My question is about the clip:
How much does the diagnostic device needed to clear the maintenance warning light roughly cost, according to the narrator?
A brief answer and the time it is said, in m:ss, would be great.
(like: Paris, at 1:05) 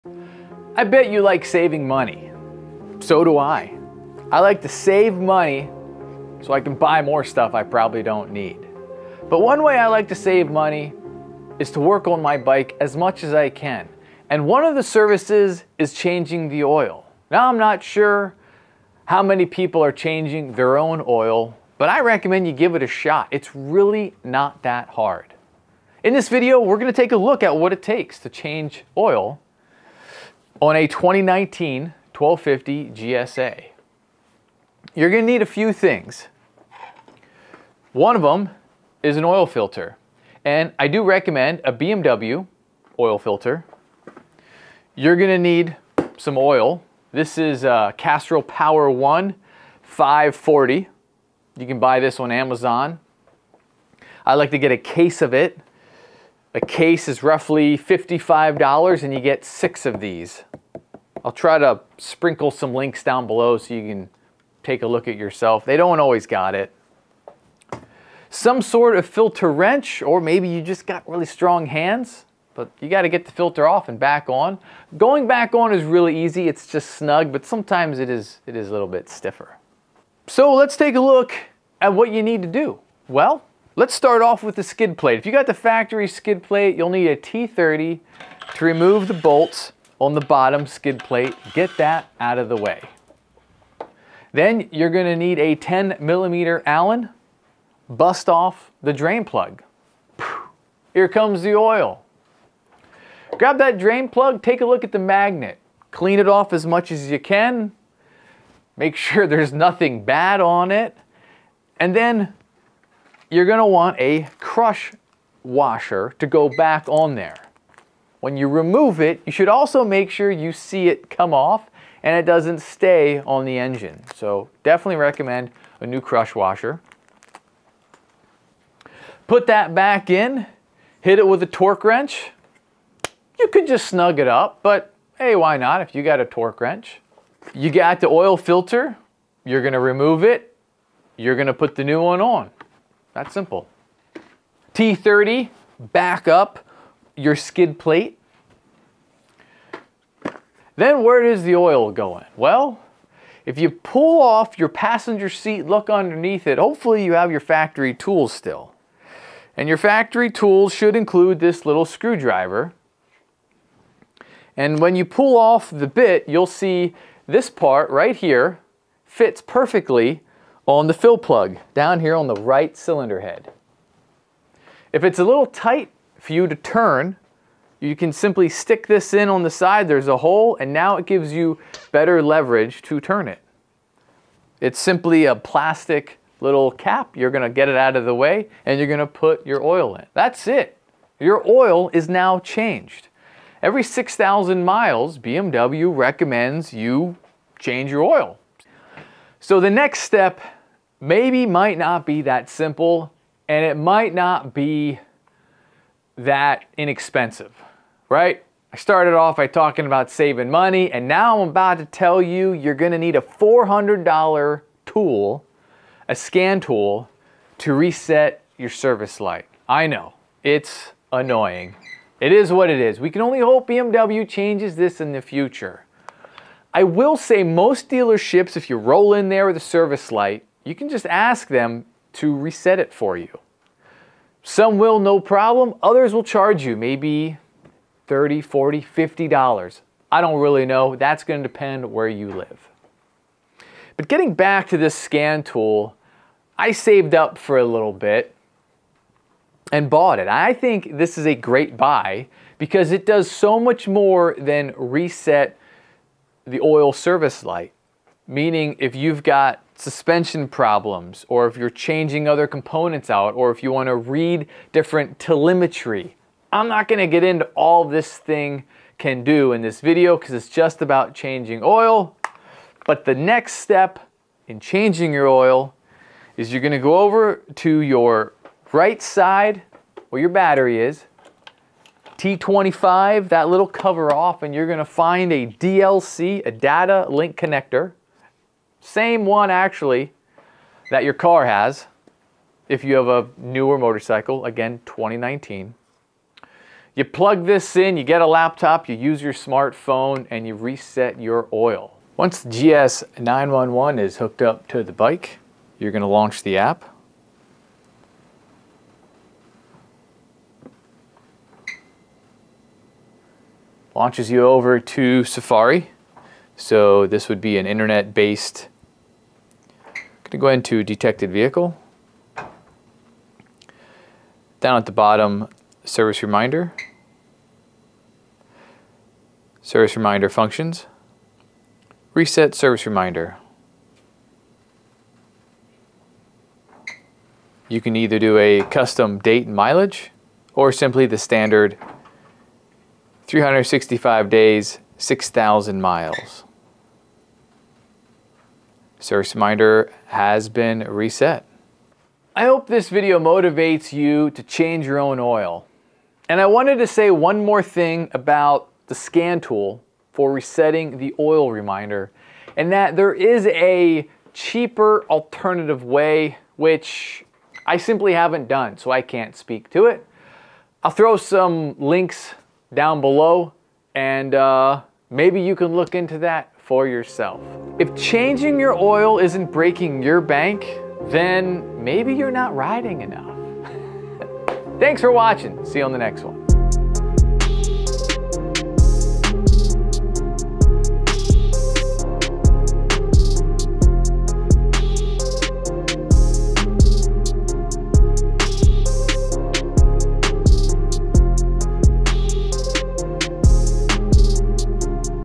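$400, at 3:33.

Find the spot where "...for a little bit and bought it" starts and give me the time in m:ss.
4:07.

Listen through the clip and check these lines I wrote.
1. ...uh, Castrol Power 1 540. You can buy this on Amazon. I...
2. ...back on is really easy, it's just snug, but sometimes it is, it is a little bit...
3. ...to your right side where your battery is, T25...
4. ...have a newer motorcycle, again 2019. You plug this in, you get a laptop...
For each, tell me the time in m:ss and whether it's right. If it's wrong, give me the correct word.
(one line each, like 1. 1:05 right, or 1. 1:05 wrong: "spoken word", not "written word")
1. 0:47 right
2. 1:15 right
3. 4:37 right
4. 4:52 right.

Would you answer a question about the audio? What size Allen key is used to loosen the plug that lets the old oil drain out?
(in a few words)
10 millimeter.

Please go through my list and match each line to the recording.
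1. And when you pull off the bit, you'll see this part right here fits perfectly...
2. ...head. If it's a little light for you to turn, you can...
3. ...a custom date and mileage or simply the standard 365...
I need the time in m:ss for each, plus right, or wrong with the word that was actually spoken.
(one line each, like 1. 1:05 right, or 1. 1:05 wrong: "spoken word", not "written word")
1. 2:44 right
2. 2:53 wrong: "tight", not "light"
3. 5:38 right.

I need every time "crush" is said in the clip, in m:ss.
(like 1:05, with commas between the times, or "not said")
1:54, 2:06.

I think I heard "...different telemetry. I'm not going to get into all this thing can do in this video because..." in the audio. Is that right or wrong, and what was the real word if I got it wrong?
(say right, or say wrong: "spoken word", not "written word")
right.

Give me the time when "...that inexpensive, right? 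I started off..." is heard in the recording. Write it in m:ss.
3:26.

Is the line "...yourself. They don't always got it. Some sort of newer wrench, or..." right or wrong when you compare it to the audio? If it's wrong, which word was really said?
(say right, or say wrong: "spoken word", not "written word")
wrong: "filter", not "newer".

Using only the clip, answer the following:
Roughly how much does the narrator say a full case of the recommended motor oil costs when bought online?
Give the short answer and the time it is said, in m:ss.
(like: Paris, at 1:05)
$55, at 0:57.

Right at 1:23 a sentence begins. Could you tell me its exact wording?
Well, Let's start off with the skid plate.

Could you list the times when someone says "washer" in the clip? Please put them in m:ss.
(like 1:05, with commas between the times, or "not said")
1:55, 2:06.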